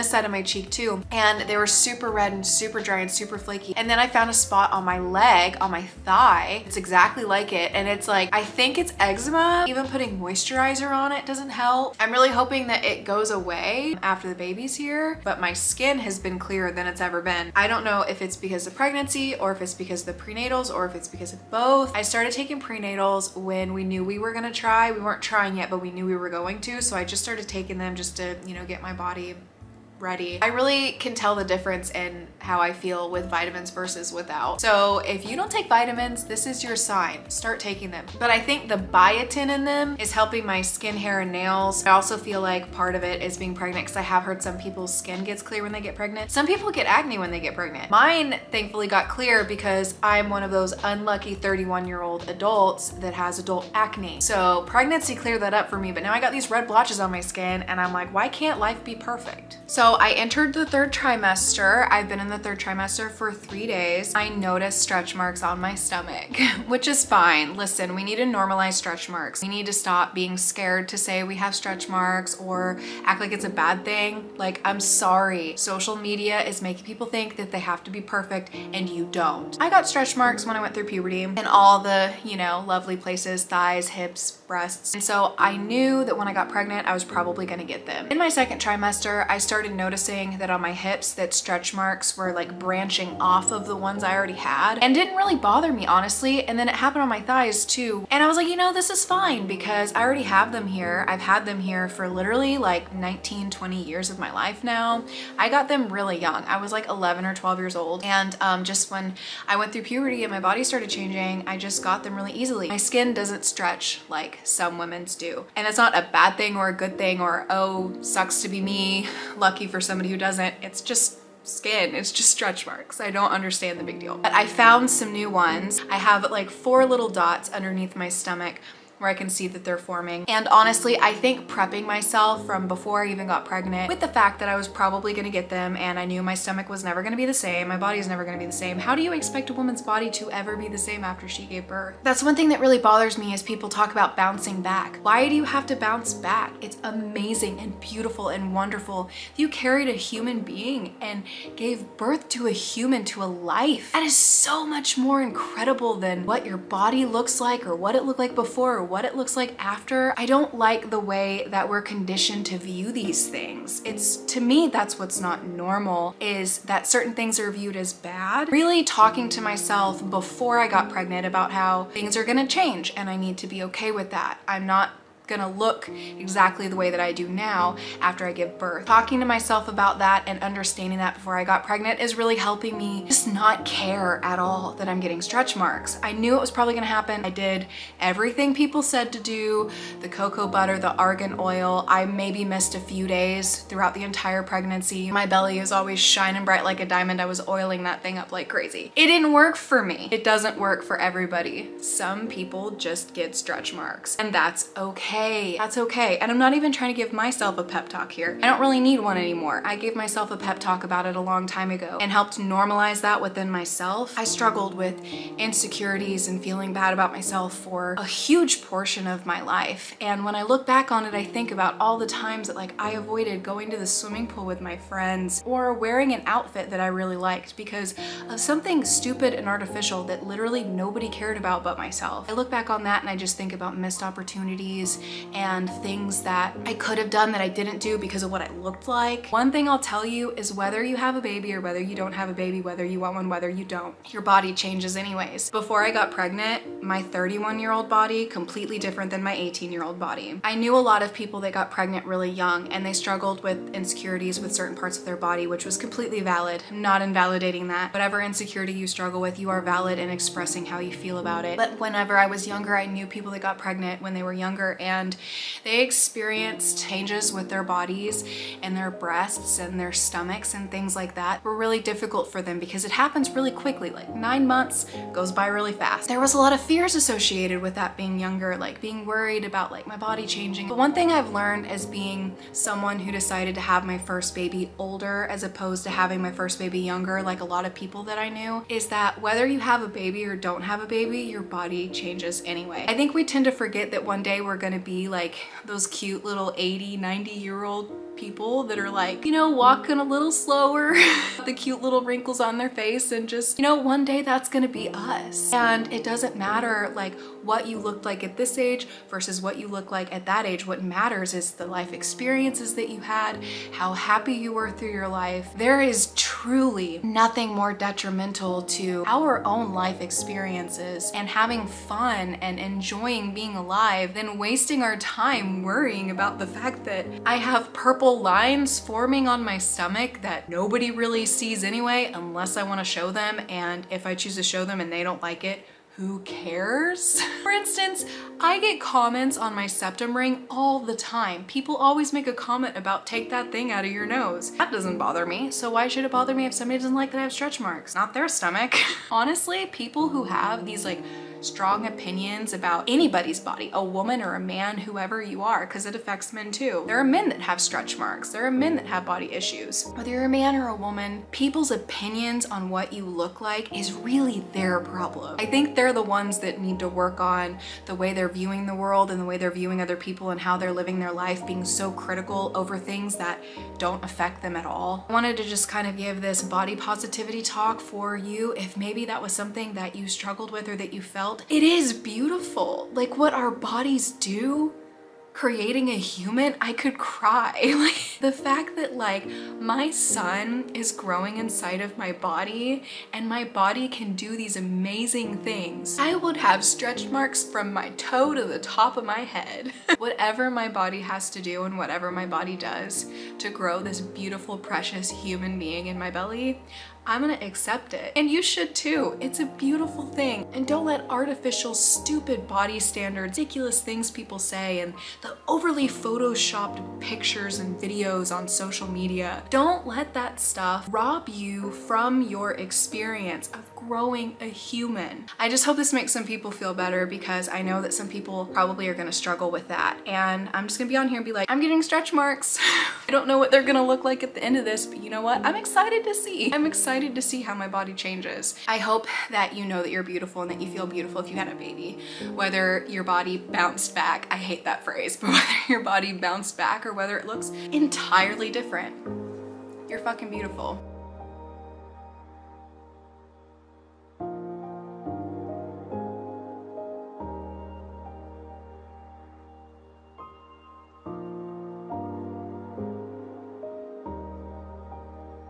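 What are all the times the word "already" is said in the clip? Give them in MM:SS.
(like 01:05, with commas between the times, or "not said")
01:34, 01:40.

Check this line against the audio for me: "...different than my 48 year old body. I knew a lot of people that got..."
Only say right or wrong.
wrong.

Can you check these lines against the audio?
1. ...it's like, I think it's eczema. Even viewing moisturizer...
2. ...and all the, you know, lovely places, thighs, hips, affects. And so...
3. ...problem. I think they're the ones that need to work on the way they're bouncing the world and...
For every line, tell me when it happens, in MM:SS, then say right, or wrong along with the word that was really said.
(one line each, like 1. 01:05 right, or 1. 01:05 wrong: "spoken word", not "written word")
1. 00:07 wrong: "putting", not "viewing"
2. 01:21 wrong: "breasts", not "affects"
3. 06:04 wrong: "viewing", not "bouncing".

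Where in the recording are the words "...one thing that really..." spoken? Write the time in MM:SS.
02:22.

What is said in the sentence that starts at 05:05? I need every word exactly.
And it doesn't matter like what you looked like at this age versus what you look like at that age.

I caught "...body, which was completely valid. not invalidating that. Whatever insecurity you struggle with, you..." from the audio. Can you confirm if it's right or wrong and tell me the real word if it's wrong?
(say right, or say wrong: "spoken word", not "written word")
right.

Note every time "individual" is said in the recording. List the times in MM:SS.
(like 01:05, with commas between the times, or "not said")
not said.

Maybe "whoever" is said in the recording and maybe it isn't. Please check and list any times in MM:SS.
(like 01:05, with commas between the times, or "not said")
05:54.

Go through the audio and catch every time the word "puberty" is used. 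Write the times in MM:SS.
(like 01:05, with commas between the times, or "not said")
01:20, 01:49.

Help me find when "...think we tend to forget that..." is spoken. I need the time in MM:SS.
04:52.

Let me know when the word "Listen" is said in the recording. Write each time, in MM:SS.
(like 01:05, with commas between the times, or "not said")
01:07.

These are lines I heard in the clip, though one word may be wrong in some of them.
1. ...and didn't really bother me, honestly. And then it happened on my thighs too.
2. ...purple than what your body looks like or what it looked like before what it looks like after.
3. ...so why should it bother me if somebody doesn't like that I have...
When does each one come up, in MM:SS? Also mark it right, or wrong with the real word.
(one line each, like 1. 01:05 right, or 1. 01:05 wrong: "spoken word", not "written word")
1. 01:34 right
2. 02:35 wrong: "incredible", not "purple"
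3. 05:45 right.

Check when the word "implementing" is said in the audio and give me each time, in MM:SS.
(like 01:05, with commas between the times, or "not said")
not said.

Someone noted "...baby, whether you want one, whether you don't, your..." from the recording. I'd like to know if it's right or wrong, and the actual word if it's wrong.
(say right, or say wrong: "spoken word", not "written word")
right.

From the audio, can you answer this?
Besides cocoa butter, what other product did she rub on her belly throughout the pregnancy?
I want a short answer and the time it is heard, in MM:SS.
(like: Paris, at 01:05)
argan oil, at 03:10.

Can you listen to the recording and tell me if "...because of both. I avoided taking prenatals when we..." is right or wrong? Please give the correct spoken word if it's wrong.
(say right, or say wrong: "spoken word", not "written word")
wrong: "started", not "avoided".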